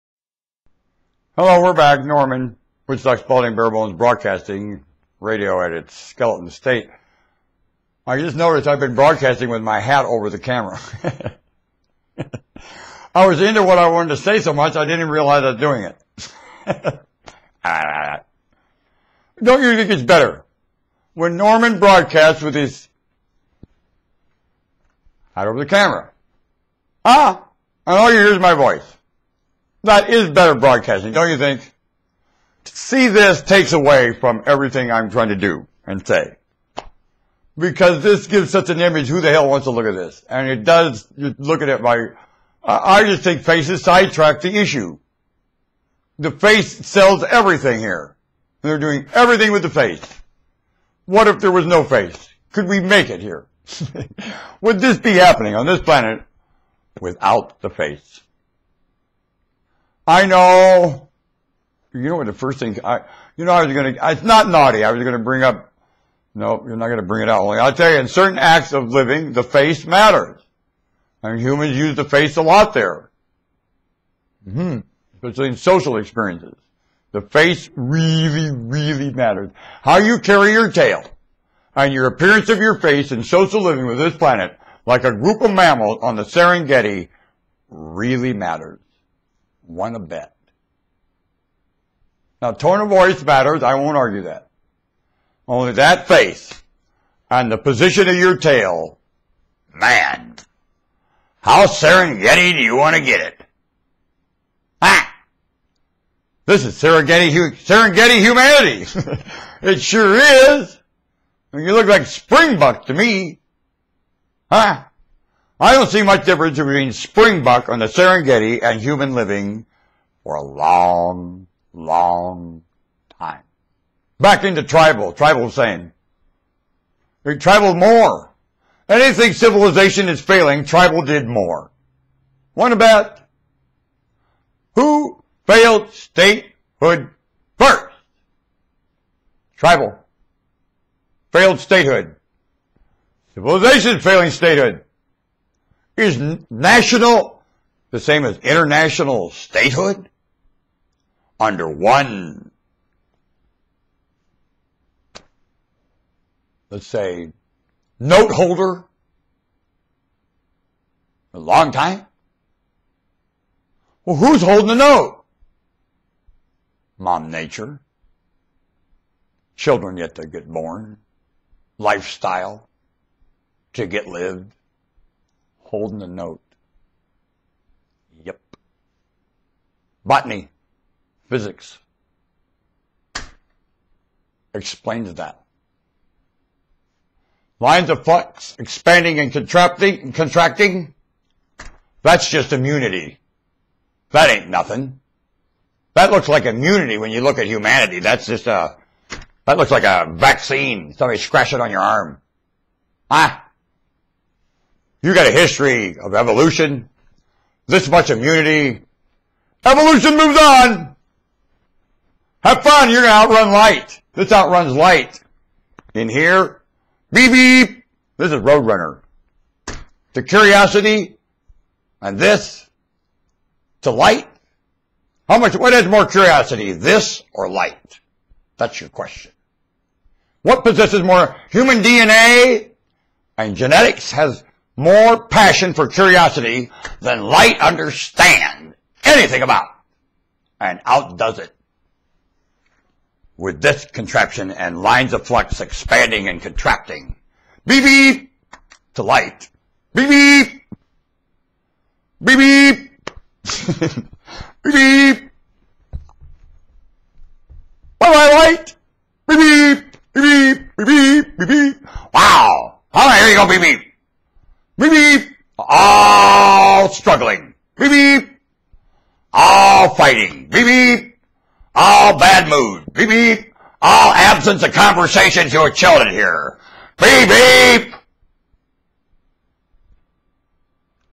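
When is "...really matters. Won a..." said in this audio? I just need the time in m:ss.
1:27.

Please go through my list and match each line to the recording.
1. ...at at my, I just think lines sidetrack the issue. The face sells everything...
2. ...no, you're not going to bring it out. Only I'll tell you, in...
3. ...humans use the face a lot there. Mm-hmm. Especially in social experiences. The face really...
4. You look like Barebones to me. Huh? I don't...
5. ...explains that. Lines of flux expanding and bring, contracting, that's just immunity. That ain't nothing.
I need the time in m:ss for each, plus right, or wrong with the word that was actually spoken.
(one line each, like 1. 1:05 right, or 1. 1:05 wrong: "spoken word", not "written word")
1. 0:41 wrong: "faces", not "lines"
2. 1:06 right
3. 1:11 right
4. 1:51 wrong: "Springbuck", not "Barebones"
5. 3:04 wrong: "contracting", not "bring".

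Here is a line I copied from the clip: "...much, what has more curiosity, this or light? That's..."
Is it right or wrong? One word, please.
right.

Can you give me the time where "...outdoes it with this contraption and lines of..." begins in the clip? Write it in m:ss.
4:00.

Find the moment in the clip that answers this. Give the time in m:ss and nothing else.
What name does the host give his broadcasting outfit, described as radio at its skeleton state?
0:02.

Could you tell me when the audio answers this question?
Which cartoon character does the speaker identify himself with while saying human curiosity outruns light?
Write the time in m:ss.
3:38.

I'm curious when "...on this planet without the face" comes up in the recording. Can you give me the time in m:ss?
0:55.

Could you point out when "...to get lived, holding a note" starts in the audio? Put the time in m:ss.
2:53.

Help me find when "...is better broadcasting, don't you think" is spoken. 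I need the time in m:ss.
0:30.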